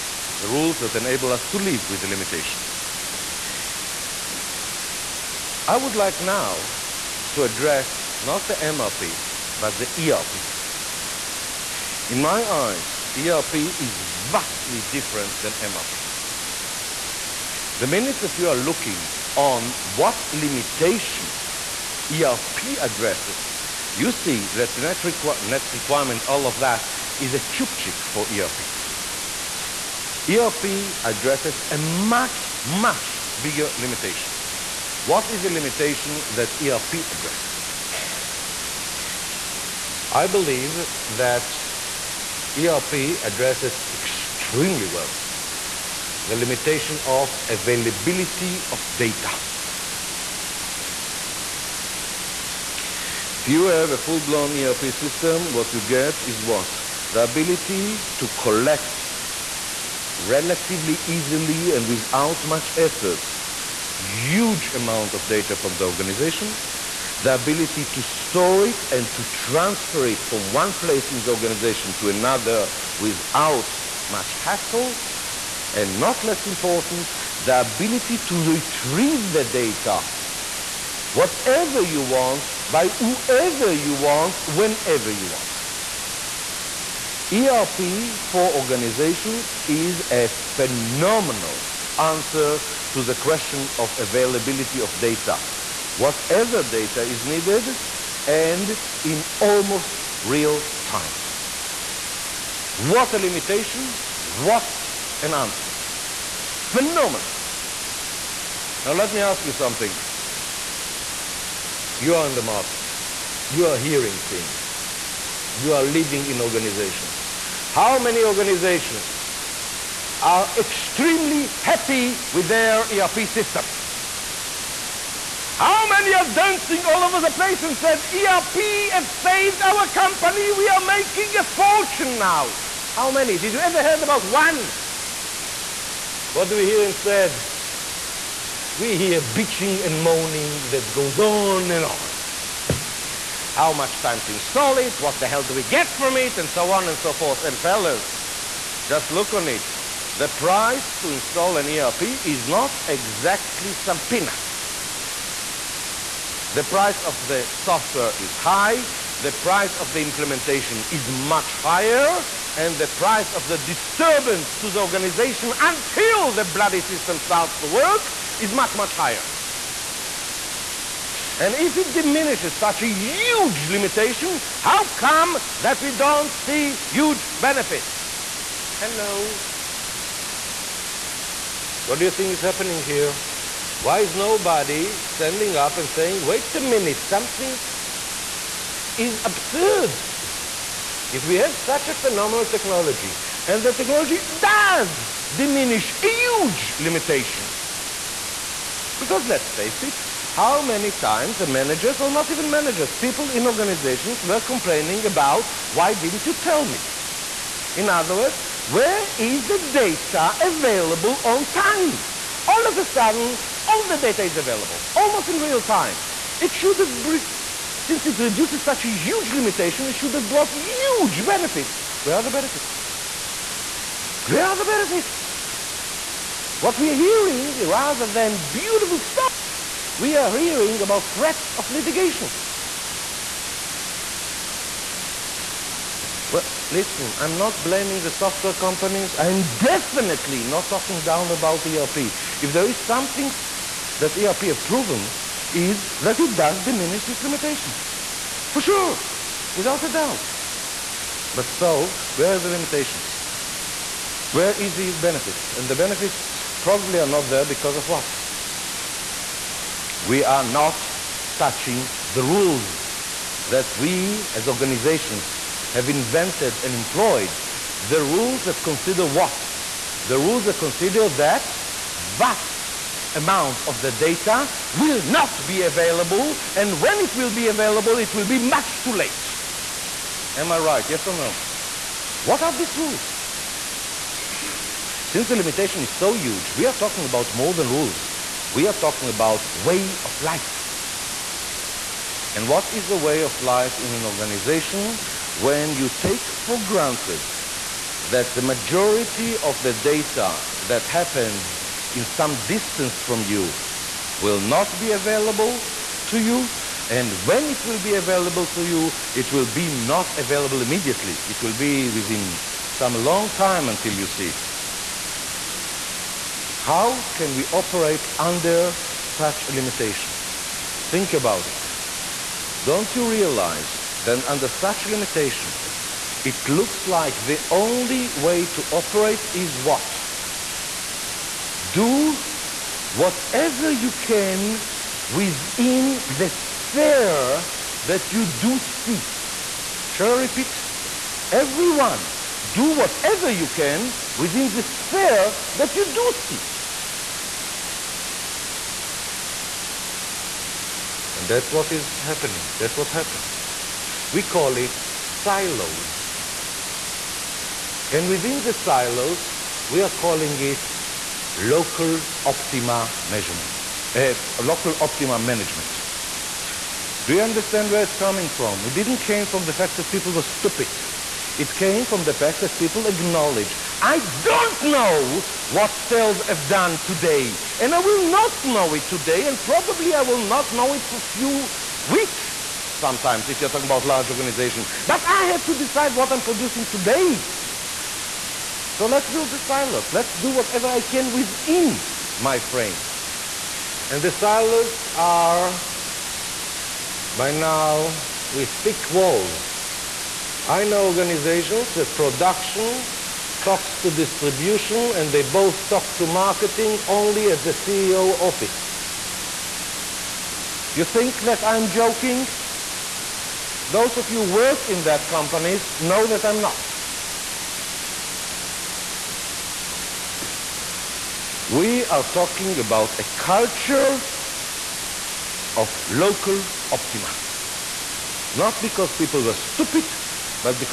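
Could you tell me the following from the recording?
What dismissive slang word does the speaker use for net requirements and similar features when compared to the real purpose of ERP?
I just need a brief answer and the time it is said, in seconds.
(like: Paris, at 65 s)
chupchik, at 27 s.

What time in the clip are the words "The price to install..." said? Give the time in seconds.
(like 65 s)
150 s.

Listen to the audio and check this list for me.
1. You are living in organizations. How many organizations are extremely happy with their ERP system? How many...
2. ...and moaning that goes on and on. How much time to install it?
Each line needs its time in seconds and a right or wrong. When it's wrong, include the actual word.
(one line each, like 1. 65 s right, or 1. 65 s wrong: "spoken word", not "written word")
1. 115 s right
2. 139 s right.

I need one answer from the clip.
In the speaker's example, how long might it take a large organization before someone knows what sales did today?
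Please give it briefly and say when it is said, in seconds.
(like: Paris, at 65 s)
a few weeks, at 380 s.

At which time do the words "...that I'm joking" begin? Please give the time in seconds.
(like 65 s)
411 s.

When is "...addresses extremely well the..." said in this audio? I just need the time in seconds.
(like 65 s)
43 s.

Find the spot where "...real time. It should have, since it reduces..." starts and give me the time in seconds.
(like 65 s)
215 s.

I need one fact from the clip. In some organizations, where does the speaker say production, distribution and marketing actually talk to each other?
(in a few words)
the CEO office.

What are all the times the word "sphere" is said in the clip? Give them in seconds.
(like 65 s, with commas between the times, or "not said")
336 s, 344 s.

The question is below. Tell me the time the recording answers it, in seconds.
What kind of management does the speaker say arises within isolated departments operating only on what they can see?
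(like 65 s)
364 s.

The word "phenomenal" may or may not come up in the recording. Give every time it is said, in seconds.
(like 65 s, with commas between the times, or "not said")
90 s, 106 s, 191 s.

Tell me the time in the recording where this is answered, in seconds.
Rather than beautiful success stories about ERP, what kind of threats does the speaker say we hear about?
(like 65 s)
231 s.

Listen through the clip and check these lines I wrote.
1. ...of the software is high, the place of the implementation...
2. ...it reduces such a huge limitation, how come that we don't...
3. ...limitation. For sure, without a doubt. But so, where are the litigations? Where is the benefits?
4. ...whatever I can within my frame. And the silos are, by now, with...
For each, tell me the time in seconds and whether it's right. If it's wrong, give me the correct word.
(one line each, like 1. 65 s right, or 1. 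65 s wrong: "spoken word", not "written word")
1. 157 s wrong: "price", not "place"
2. 171 s wrong: "diminishes", not "reduces"
3. 247 s wrong: "limitations", not "litigations"
4. 390 s right.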